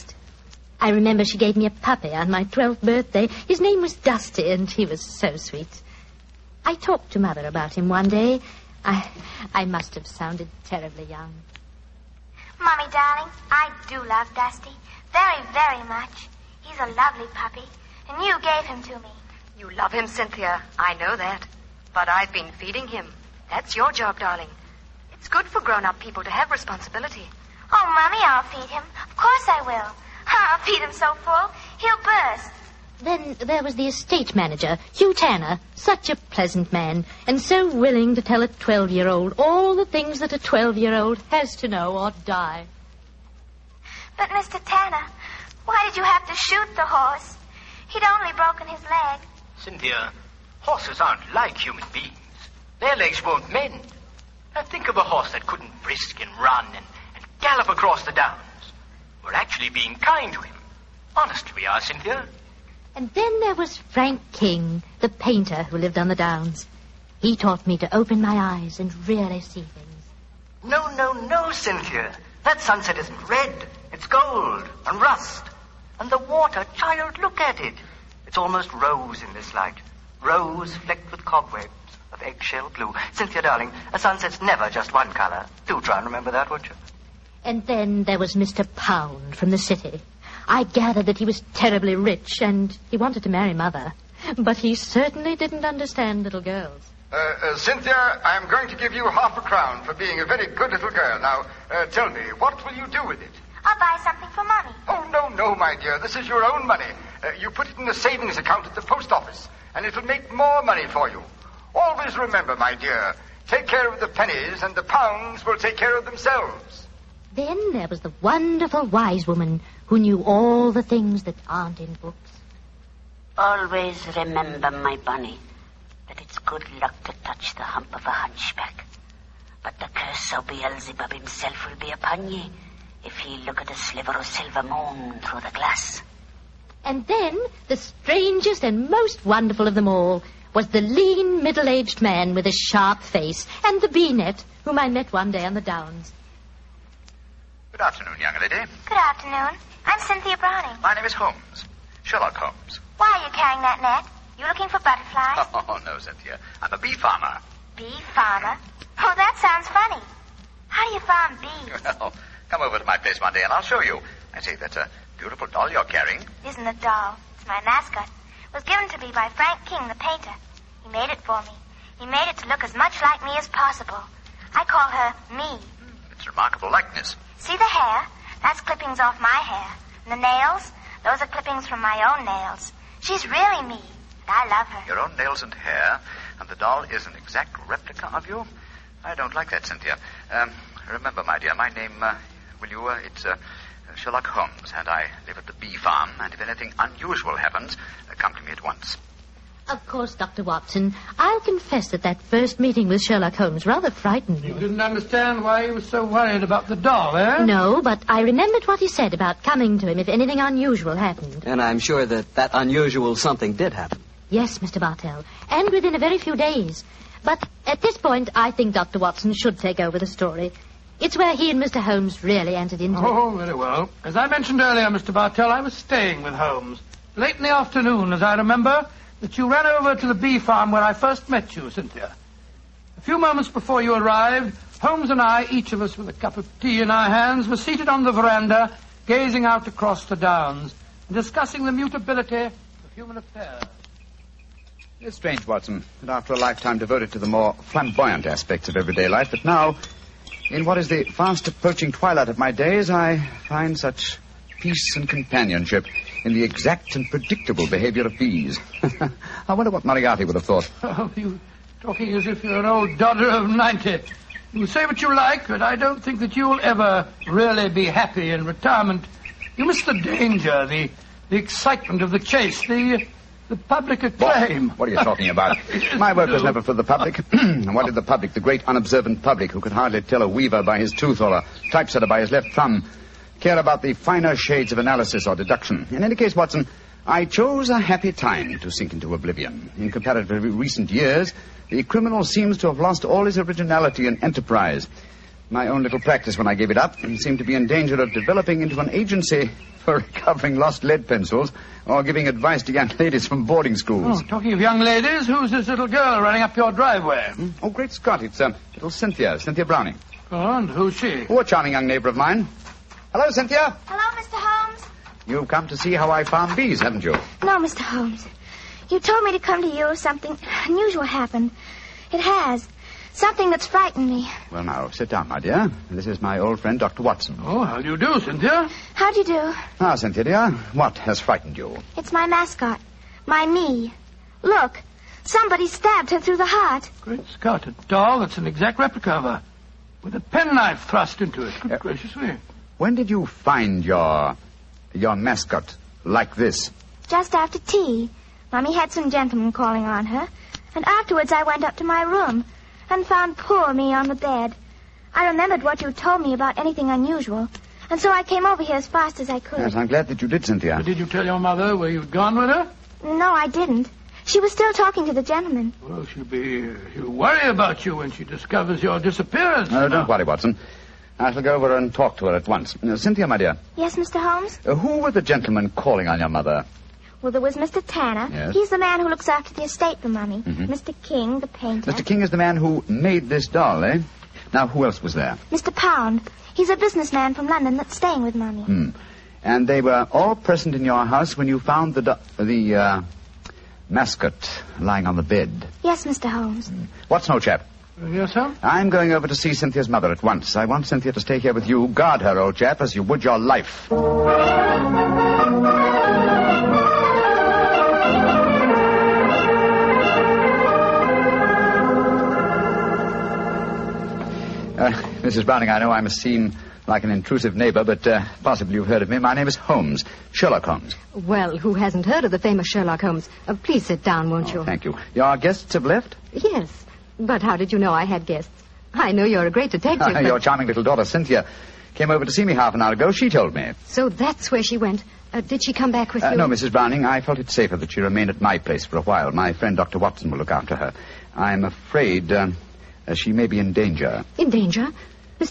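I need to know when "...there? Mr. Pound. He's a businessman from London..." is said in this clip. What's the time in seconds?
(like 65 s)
385 s.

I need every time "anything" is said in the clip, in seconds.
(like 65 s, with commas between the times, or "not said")
196 s, 210 s, 356 s.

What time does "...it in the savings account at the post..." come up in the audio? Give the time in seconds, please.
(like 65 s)
107 s.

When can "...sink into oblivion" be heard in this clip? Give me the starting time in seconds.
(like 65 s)
288 s.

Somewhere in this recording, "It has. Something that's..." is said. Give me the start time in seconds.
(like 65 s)
322 s.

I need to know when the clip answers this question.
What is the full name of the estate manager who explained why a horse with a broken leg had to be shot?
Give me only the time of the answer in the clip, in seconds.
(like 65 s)
34 s.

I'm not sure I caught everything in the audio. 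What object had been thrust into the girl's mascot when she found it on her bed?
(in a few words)
a penknife.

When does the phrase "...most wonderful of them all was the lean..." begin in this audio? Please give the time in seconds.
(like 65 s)
138 s.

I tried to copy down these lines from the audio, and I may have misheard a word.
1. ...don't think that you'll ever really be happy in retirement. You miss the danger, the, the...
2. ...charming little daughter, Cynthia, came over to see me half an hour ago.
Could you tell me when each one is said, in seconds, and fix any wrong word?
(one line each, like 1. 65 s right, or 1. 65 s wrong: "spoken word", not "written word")
1. 265 s right
2. 430 s right.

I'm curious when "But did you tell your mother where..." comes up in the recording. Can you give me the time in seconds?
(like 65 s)
360 s.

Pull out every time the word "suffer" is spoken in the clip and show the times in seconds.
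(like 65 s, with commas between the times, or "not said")
not said.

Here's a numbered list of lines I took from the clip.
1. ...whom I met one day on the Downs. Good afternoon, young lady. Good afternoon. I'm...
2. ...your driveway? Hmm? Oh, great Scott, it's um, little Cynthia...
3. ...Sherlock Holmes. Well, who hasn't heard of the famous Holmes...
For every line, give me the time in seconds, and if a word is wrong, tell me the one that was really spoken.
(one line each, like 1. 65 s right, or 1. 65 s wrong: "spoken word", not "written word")
1. 144 s right
2. 306 s right
3. 420 s wrong: "Sherlock", not "Holmes".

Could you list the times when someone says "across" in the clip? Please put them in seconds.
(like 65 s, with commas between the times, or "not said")
57 s, 239 s.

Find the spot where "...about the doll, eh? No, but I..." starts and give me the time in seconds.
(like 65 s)
206 s.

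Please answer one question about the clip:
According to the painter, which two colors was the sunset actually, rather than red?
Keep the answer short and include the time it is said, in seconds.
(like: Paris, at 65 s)
gold and rust, at 74 s.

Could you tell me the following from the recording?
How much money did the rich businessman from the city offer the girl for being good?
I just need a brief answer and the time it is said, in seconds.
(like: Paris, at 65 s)
half a crown, at 99 s.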